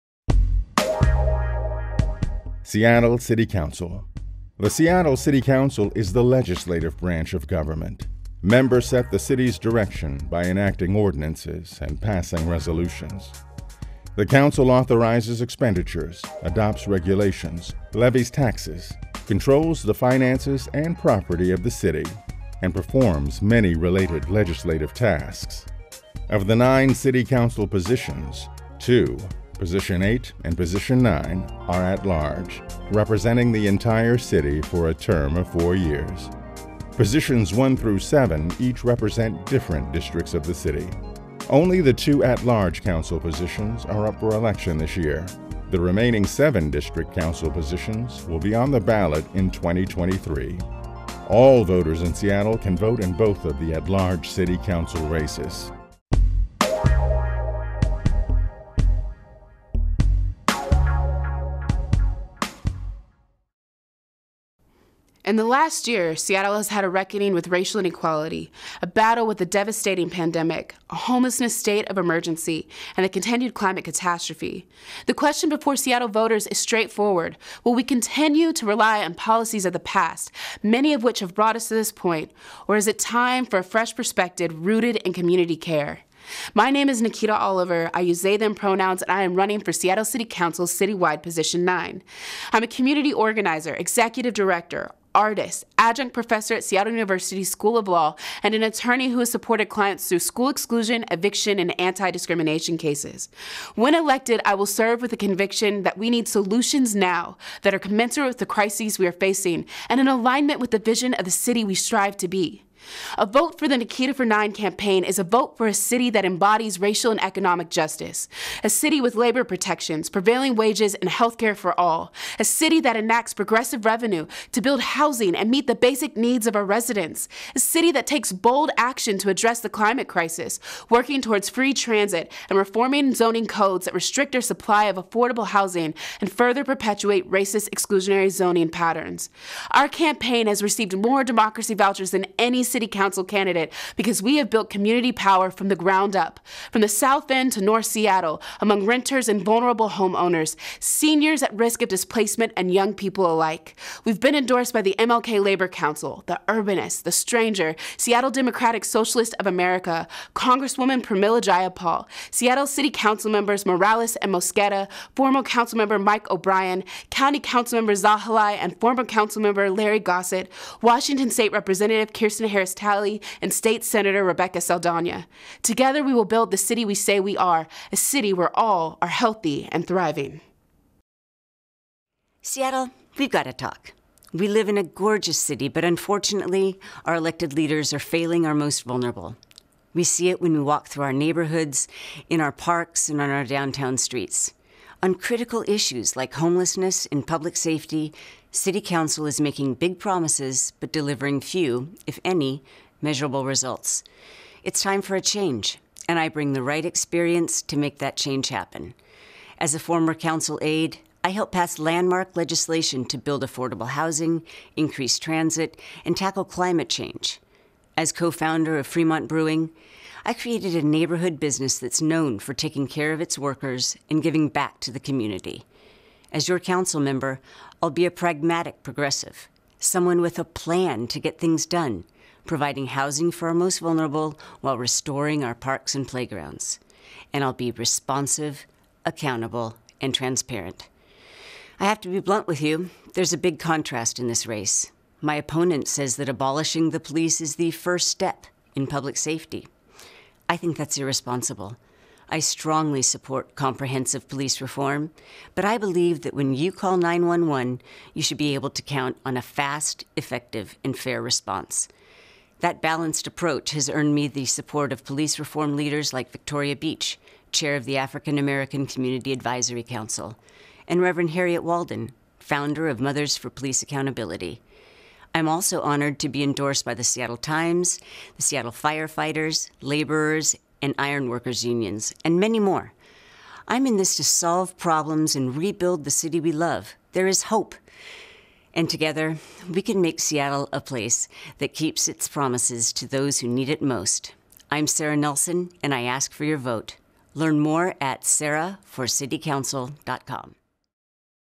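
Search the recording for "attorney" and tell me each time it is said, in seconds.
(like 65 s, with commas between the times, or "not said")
98 s.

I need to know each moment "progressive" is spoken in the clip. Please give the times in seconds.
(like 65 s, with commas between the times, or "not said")
123 s, 228 s.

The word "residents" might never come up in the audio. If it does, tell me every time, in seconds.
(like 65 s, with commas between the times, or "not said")
126 s.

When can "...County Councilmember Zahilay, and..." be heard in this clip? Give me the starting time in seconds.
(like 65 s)
167 s.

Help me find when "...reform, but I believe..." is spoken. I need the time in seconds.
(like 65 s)
254 s.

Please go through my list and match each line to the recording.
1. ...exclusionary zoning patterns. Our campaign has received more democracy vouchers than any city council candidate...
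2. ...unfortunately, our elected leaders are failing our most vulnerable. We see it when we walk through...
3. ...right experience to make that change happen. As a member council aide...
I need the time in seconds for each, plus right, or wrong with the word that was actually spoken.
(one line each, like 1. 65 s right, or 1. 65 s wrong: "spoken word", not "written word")
1. 137 s right
2. 185 s right
3. 206 s wrong: "former", not "member".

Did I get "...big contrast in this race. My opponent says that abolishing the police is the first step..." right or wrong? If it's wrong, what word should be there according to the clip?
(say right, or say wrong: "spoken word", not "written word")
right.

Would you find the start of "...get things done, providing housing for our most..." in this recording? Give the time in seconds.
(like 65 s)
231 s.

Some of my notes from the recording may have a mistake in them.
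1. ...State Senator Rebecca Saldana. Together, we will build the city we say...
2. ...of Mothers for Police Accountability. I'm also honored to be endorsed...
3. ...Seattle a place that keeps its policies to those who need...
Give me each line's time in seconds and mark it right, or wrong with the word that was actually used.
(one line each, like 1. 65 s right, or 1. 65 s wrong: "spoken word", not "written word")
1. 173 s right
2. 272 s right
3. 290 s wrong: "promises", not "policies".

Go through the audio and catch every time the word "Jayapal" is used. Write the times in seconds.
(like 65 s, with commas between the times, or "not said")
161 s.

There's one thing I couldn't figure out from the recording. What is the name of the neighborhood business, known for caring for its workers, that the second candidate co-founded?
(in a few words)
Fremont Brewing.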